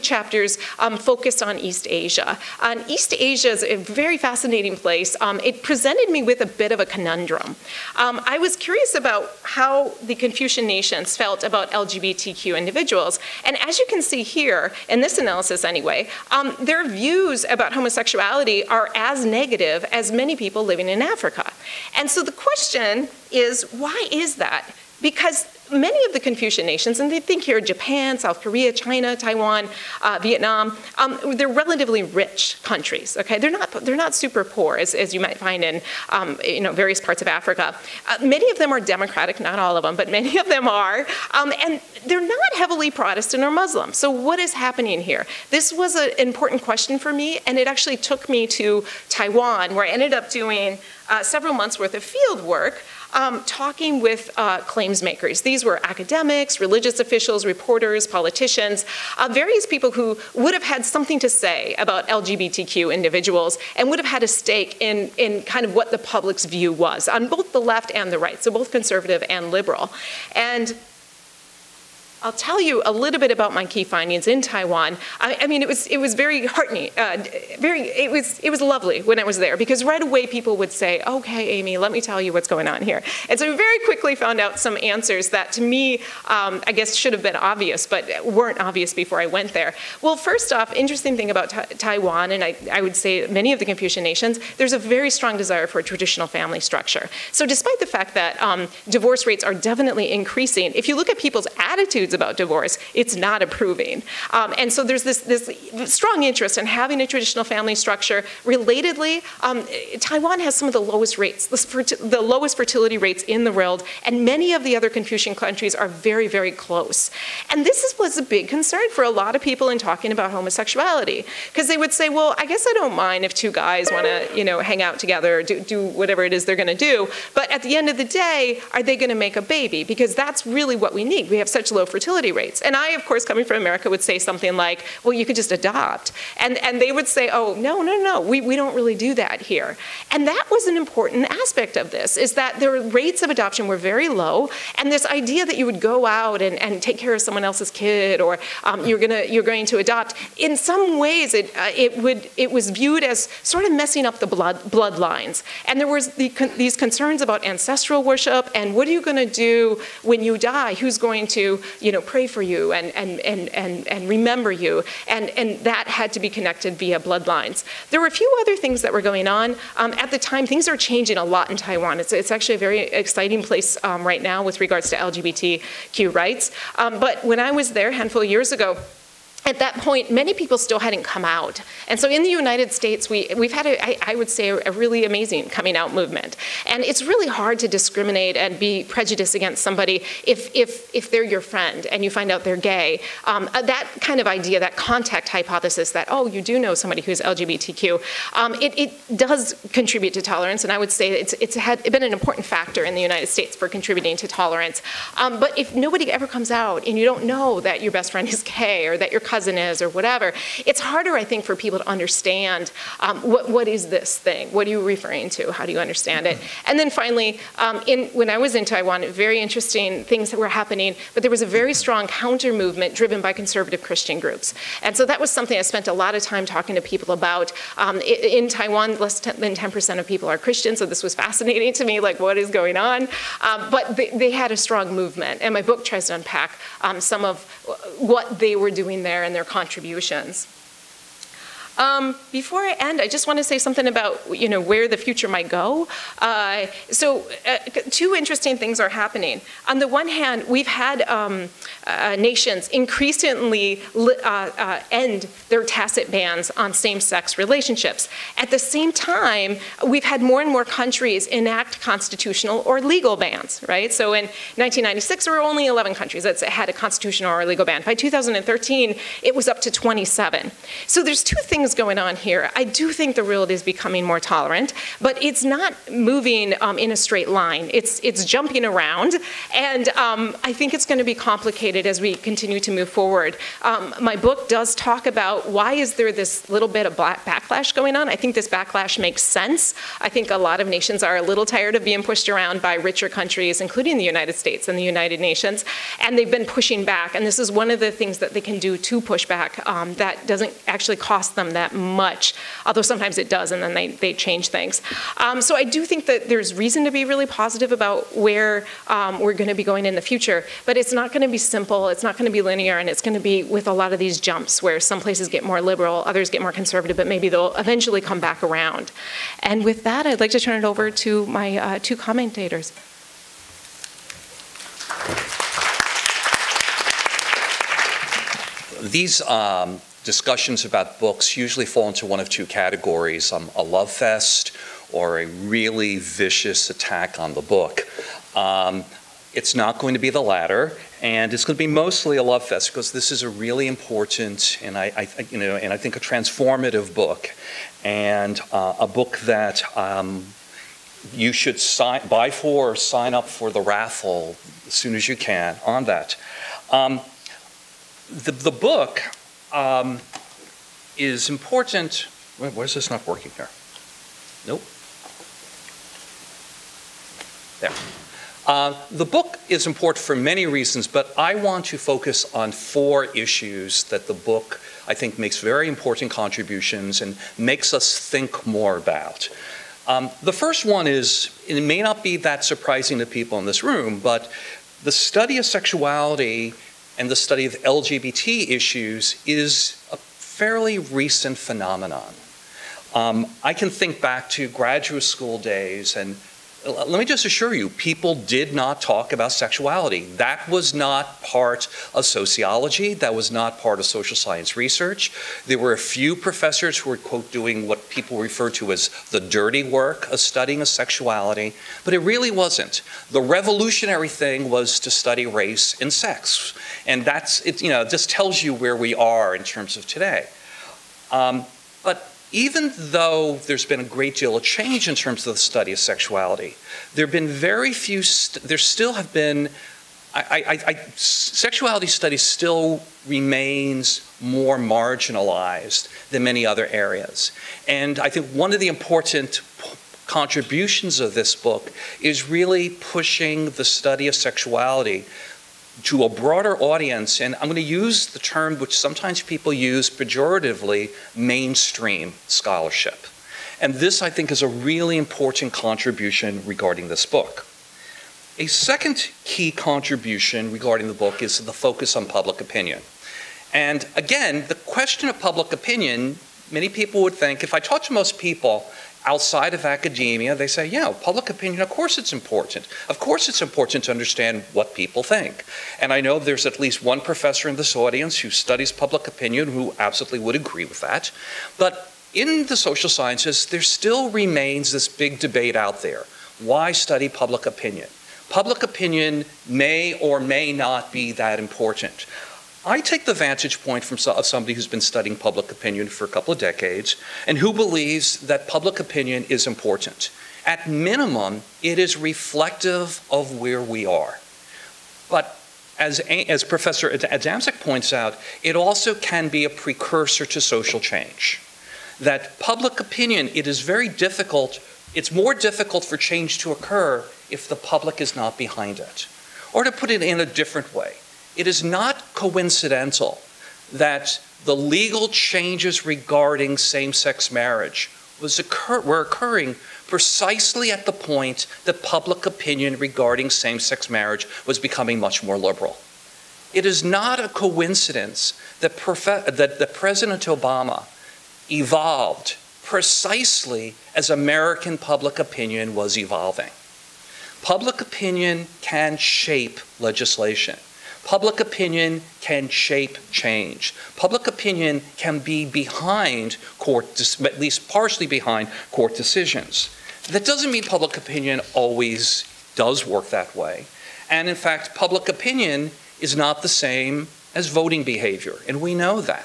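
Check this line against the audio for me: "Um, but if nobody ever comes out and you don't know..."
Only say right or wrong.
right.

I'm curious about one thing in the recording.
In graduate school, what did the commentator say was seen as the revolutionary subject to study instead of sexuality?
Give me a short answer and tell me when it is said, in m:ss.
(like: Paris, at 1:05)
Race and sex, at 6:54.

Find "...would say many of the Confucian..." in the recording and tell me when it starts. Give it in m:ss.
1:32.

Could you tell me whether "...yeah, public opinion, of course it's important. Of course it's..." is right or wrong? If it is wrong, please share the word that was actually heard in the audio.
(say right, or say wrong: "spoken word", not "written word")
right.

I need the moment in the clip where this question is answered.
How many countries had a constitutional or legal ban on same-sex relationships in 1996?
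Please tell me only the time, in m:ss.
4:25.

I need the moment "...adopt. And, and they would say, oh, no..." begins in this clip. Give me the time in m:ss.
2:15.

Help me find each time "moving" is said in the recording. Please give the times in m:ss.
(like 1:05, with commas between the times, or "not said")
4:35.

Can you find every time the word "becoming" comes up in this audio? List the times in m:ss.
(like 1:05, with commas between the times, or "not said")
4:33, 8:54.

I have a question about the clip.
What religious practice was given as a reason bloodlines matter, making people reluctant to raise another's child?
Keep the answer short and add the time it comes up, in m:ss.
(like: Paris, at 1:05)
Ancestral worship, at 2:37.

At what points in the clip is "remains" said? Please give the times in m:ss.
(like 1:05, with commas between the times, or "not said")
7:13, 8:04.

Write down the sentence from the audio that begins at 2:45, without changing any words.
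And, and that had to be connected via bloodlines.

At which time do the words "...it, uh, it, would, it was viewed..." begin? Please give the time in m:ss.
2:31.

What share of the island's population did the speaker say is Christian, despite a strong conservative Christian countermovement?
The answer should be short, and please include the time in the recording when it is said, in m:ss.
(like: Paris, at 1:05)
Less than 10%, at 3:48.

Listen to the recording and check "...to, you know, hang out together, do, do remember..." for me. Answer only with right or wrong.
wrong.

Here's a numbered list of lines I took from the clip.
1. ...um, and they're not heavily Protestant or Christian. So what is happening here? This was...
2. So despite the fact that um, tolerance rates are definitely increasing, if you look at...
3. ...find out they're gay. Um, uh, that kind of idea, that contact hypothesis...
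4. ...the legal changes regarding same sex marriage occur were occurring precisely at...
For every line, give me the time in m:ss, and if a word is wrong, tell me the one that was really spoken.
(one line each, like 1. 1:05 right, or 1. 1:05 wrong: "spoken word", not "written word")
1. 0:41 wrong: "Muslim", not "Christian"
2. 1:37 wrong: "divorce", not "tolerance"
3. 3:12 right
4. 8:44 right.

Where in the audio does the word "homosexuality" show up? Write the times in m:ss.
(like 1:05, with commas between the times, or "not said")
0:17, 2:00.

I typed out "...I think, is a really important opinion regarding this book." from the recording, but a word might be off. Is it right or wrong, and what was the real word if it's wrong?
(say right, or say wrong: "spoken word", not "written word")
wrong: "contribution", not "opinion".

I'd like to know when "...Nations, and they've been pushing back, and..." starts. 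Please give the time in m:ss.
4:55.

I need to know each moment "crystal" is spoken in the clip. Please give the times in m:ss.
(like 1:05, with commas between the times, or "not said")
not said.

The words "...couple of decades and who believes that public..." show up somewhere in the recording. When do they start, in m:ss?
8:16.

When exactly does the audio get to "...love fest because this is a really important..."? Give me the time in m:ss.
5:42.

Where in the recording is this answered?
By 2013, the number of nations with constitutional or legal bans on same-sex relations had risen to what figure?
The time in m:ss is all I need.
4:29.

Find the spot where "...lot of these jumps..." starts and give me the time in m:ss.
5:13.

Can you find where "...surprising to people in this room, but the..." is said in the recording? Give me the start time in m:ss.
6:22.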